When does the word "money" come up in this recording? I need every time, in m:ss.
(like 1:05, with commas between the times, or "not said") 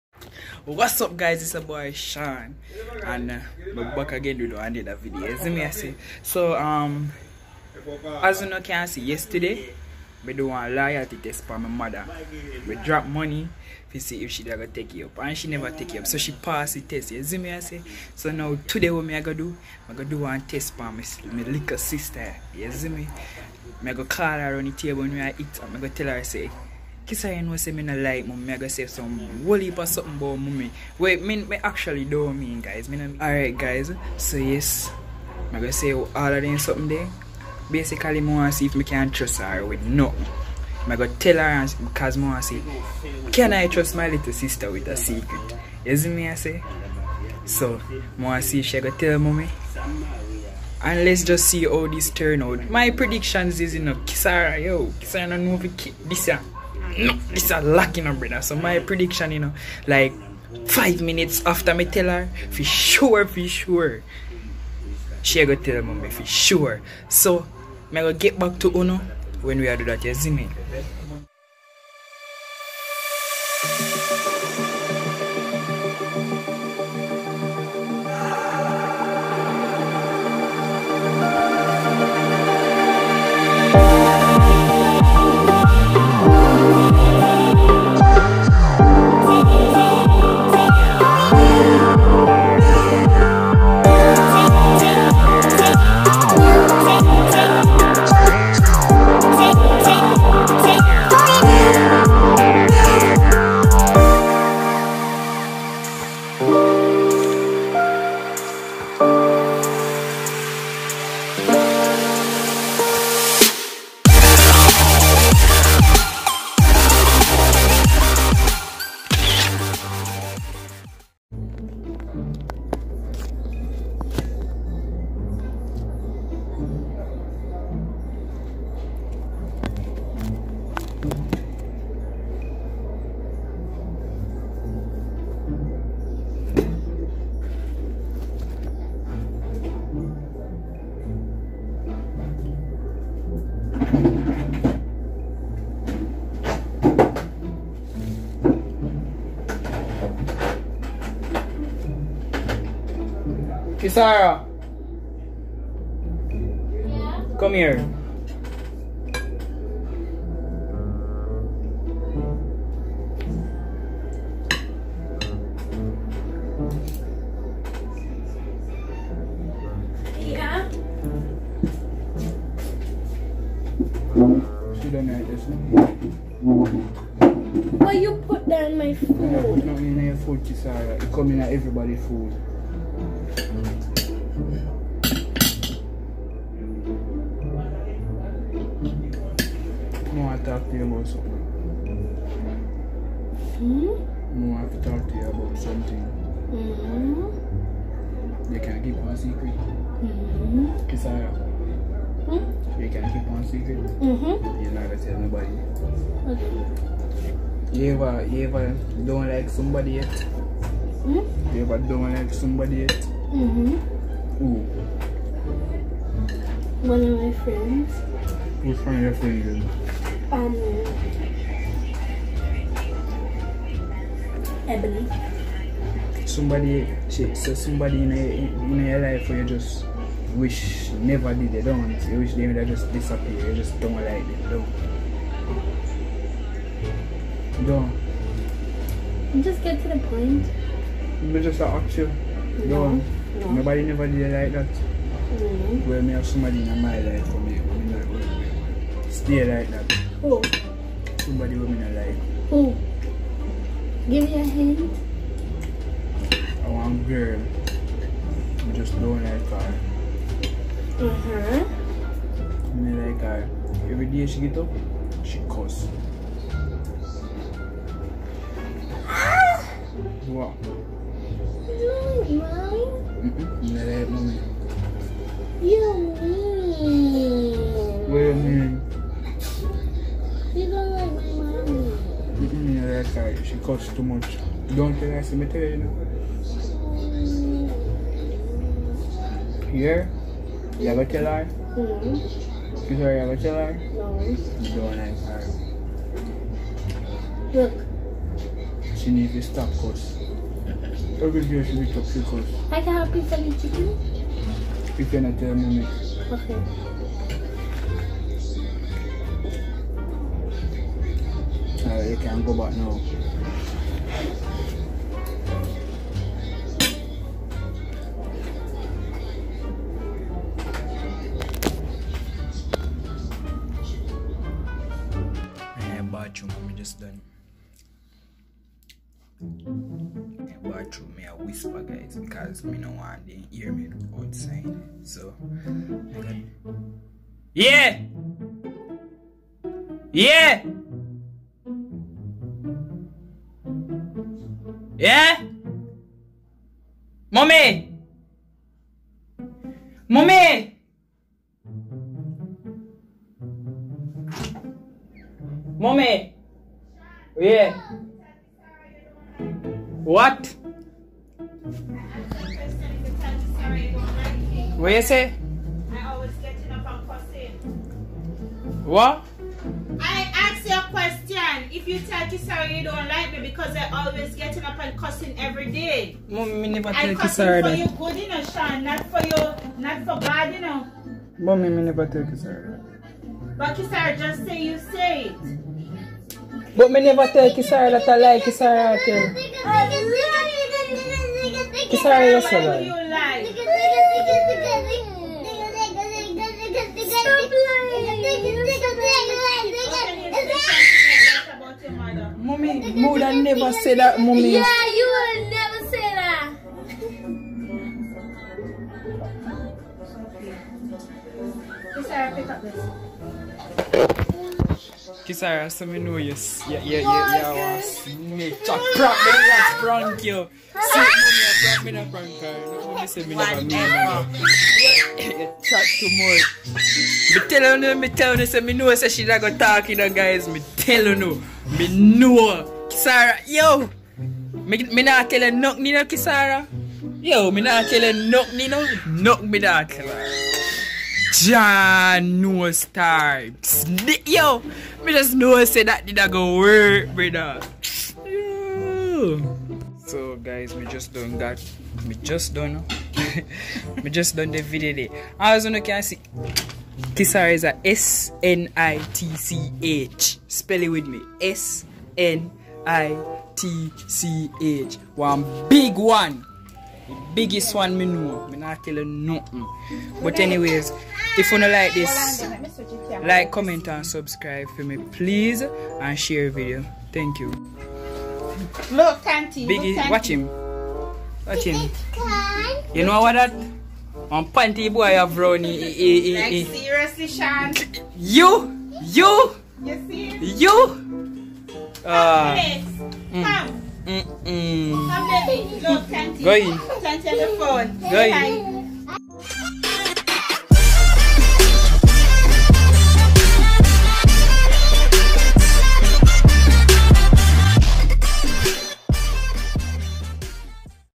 0:13.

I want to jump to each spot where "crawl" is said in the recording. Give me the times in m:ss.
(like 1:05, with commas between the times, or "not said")
not said.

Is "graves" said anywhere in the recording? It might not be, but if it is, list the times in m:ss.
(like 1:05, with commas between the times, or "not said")
not said.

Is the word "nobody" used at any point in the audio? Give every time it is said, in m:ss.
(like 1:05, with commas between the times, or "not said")
3:25, 4:03.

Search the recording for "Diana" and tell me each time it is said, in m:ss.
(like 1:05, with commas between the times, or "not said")
not said.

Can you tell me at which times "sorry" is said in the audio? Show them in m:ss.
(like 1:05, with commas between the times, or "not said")
4:52, 6:32.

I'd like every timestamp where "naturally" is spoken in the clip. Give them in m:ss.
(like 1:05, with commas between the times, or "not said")
not said.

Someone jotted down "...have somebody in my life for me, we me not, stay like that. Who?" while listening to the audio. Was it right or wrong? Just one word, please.
right.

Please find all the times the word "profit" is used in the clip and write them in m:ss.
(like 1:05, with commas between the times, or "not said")
not said.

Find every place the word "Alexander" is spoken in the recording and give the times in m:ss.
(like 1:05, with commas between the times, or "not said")
not said.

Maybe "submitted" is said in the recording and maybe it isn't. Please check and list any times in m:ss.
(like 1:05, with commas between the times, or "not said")
4:45.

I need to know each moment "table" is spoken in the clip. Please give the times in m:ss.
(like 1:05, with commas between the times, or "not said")
0:24.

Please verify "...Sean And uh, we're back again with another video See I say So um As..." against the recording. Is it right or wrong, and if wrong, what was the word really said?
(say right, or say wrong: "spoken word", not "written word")
right.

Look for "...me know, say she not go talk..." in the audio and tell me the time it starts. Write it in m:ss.
7:08.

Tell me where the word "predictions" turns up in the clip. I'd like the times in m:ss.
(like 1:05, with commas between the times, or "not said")
0:52, 0:58.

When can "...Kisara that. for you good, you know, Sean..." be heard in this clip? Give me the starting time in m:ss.
6:17.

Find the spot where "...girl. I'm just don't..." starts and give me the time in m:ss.
4:17.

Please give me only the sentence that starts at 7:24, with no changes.
Yo, me just know say that did not go work, brother.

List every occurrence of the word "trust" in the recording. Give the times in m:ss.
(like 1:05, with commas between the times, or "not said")
0:39, 0:43.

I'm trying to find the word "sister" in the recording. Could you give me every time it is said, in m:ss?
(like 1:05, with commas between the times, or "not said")
0:21, 0:44.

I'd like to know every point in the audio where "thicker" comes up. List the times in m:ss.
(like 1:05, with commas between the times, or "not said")
not said.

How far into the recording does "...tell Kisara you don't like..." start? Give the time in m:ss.
6:12.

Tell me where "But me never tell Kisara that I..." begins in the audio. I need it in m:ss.
6:26.